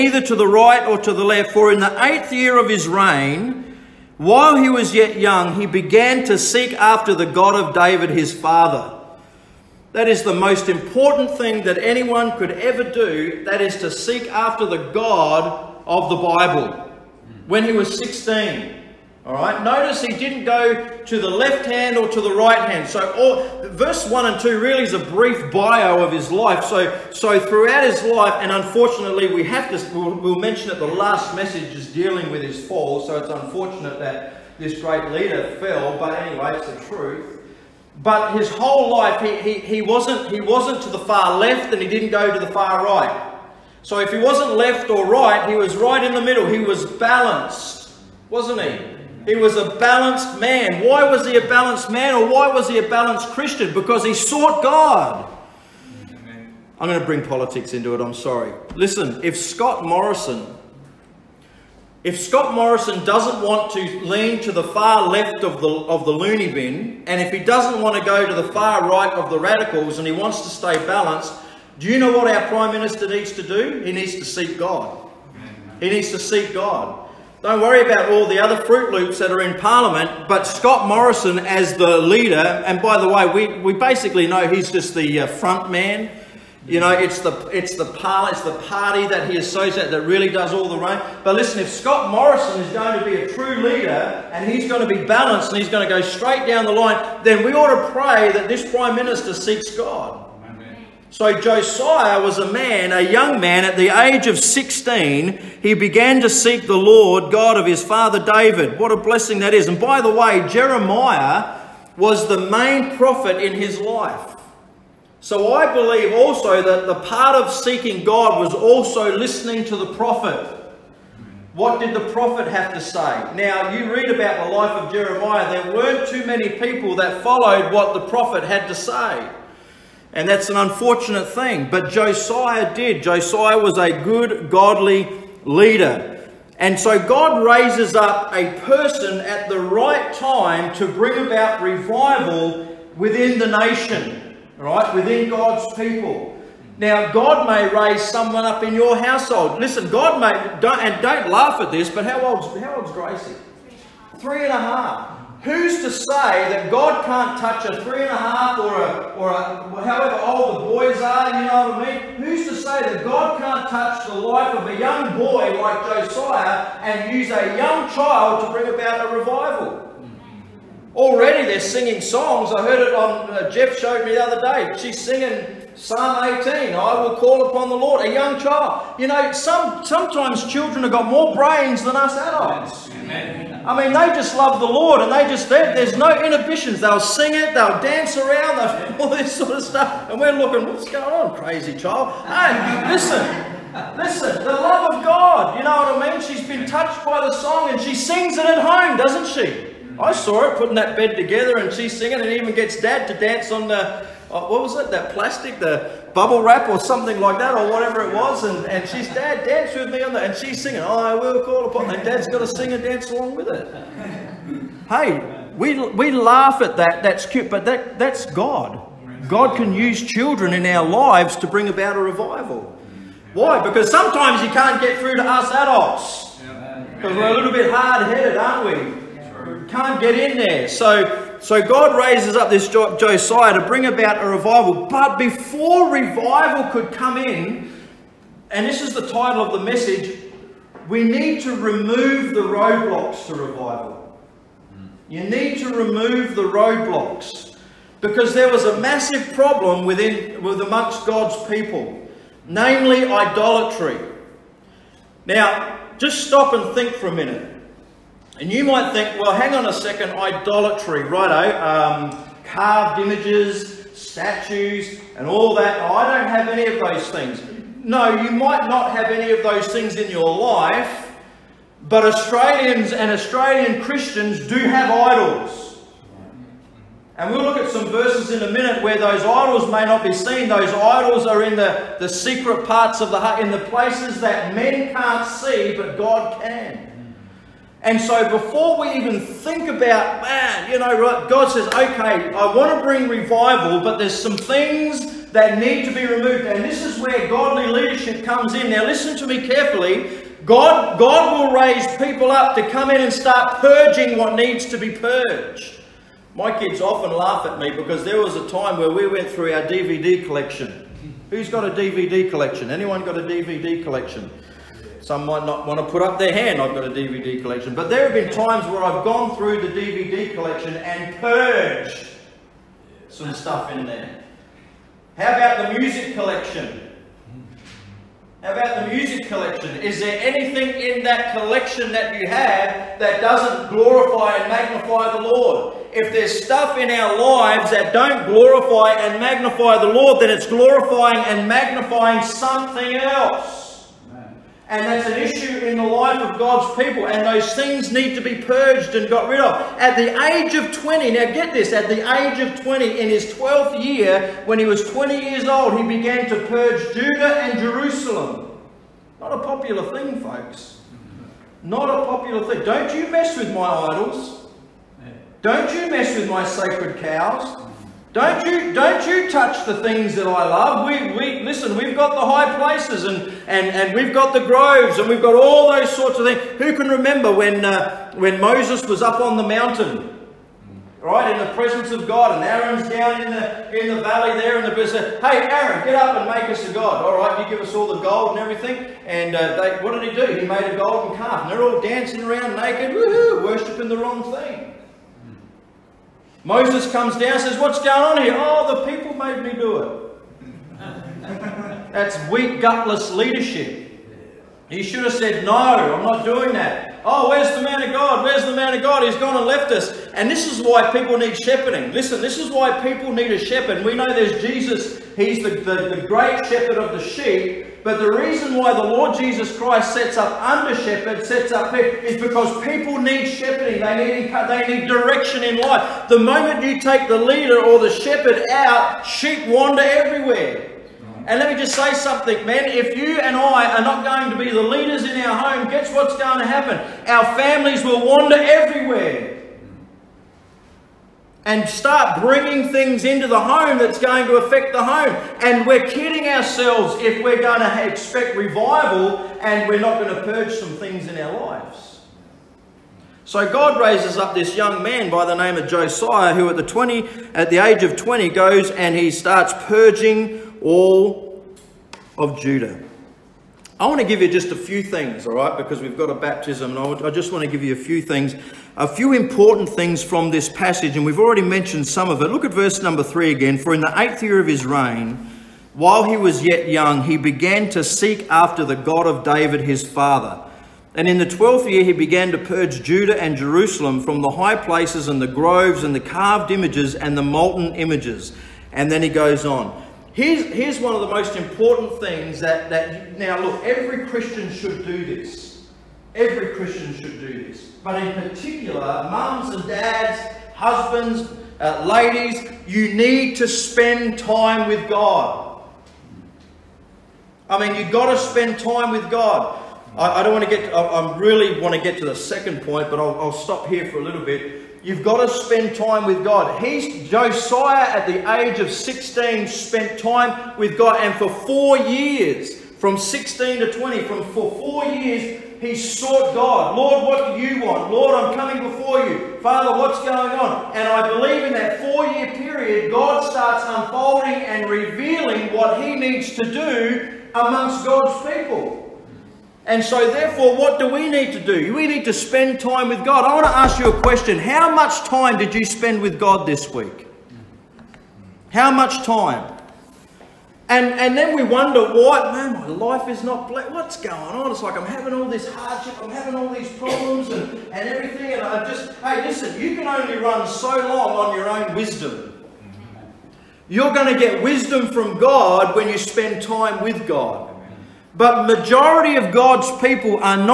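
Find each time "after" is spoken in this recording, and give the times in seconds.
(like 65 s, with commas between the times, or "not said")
6 s, 14 s, 478 s.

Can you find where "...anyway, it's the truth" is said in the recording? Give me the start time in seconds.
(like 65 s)
36 s.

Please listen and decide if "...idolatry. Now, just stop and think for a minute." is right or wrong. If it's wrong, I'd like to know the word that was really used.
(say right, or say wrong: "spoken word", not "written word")
right.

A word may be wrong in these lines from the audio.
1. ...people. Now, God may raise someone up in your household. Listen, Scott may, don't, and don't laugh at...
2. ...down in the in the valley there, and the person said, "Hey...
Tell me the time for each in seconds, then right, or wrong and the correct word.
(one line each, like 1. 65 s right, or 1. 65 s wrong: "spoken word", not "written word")
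1. 145 s wrong: "God", not "Scott"
2. 382 s right.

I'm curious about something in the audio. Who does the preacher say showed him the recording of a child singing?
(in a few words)
Jeff.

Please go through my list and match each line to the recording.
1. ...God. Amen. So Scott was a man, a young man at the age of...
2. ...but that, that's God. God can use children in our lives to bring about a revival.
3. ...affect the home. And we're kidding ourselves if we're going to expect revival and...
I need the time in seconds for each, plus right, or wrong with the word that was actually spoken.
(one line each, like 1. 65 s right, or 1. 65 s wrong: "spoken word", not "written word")
1. 99 s wrong: "Josiah", not "Scott"
2. 217 s right
3. 444 s right.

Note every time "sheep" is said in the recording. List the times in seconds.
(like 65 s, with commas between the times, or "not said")
417 s, 429 s.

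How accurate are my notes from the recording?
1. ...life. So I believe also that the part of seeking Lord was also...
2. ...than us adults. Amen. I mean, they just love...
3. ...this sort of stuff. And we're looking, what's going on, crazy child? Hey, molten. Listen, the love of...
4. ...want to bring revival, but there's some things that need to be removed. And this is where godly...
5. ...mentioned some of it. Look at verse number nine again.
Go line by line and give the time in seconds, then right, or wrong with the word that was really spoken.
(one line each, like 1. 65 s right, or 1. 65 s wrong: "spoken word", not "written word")
1. 113 s wrong: "God", not "Lord"
2. 181 s right
3. 189 s wrong: "listen", not "molten"
4. 292 s right
5. 471 s wrong: "three", not "nine".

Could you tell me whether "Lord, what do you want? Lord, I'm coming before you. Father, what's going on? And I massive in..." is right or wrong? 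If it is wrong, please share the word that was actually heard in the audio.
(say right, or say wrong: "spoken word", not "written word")
wrong: "believe", not "massive".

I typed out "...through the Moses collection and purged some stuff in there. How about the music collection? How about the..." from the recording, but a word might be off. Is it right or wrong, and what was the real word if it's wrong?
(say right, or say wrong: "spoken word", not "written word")
wrong: "DVD", not "Moses".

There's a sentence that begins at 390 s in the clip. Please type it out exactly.
He made a golden calf, and they're all dancing around naked, woohoo, worshiping the wrong thing.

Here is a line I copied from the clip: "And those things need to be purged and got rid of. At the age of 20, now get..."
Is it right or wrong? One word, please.
right.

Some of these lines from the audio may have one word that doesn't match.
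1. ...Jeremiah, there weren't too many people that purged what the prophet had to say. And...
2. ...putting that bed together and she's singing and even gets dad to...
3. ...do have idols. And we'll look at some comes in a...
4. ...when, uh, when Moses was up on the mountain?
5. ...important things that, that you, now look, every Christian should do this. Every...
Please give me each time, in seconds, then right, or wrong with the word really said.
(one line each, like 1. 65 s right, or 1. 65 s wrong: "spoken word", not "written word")
1. 124 s wrong: "followed", not "purged"
2. 200 s right
3. 274 s wrong: "verses", not "comes"
4. 377 s right
5. 491 s right.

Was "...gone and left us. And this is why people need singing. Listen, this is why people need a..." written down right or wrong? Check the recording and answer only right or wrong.
wrong.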